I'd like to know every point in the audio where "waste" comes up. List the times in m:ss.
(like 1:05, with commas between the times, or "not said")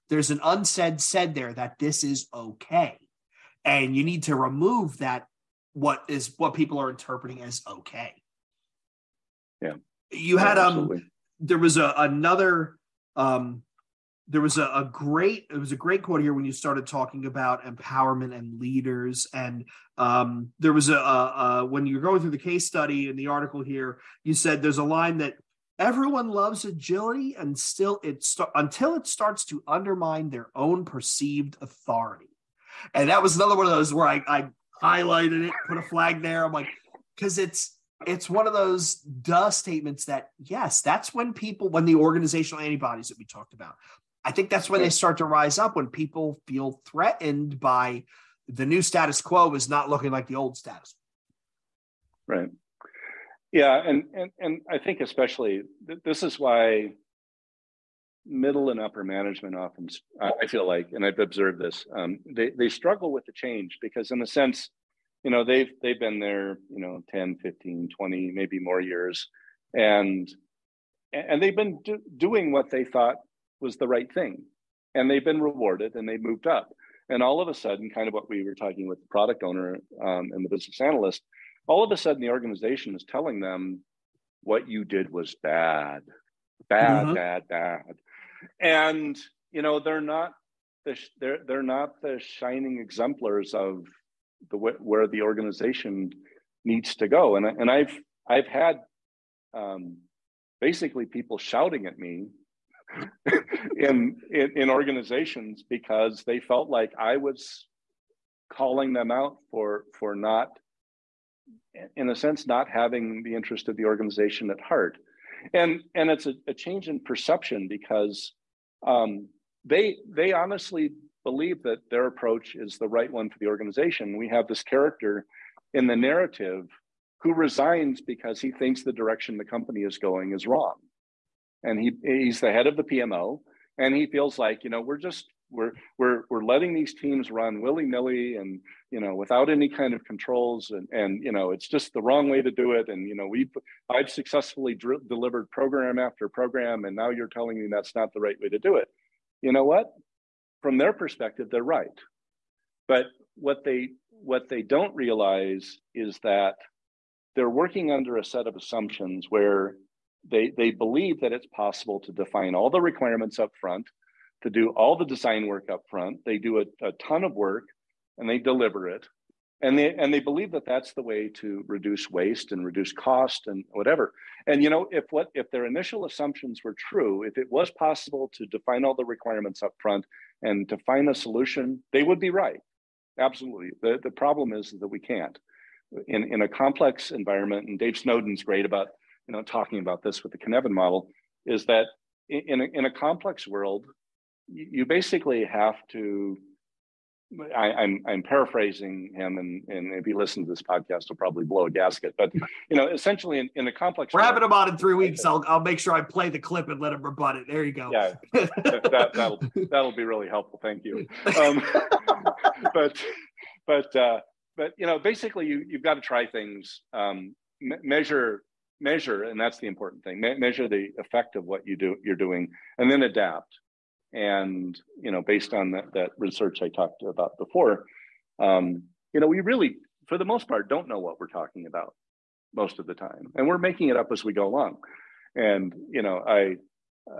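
2:52.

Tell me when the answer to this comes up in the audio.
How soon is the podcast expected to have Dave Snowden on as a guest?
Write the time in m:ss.
3:24.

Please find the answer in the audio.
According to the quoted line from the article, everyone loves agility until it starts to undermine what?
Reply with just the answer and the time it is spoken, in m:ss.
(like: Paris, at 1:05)
their own perceived authority, at 0:30.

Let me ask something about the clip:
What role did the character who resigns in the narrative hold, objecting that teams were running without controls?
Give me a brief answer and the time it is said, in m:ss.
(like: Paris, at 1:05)
head of the PMO, at 2:12.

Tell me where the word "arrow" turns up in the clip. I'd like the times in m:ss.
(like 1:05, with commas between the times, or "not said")
not said.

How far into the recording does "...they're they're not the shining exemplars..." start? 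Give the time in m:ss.
1:31.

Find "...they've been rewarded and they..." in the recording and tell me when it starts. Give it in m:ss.
1:15.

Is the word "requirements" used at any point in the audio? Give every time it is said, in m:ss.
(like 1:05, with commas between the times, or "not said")
2:42, 2:59.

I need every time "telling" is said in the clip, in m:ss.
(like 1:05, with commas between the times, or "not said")
1:23, 2:27.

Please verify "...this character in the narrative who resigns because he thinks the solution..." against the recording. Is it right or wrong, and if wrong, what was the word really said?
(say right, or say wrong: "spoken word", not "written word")
wrong: "direction", not "solution".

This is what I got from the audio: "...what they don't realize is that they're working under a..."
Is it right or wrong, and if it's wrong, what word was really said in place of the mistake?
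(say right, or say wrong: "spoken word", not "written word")
right.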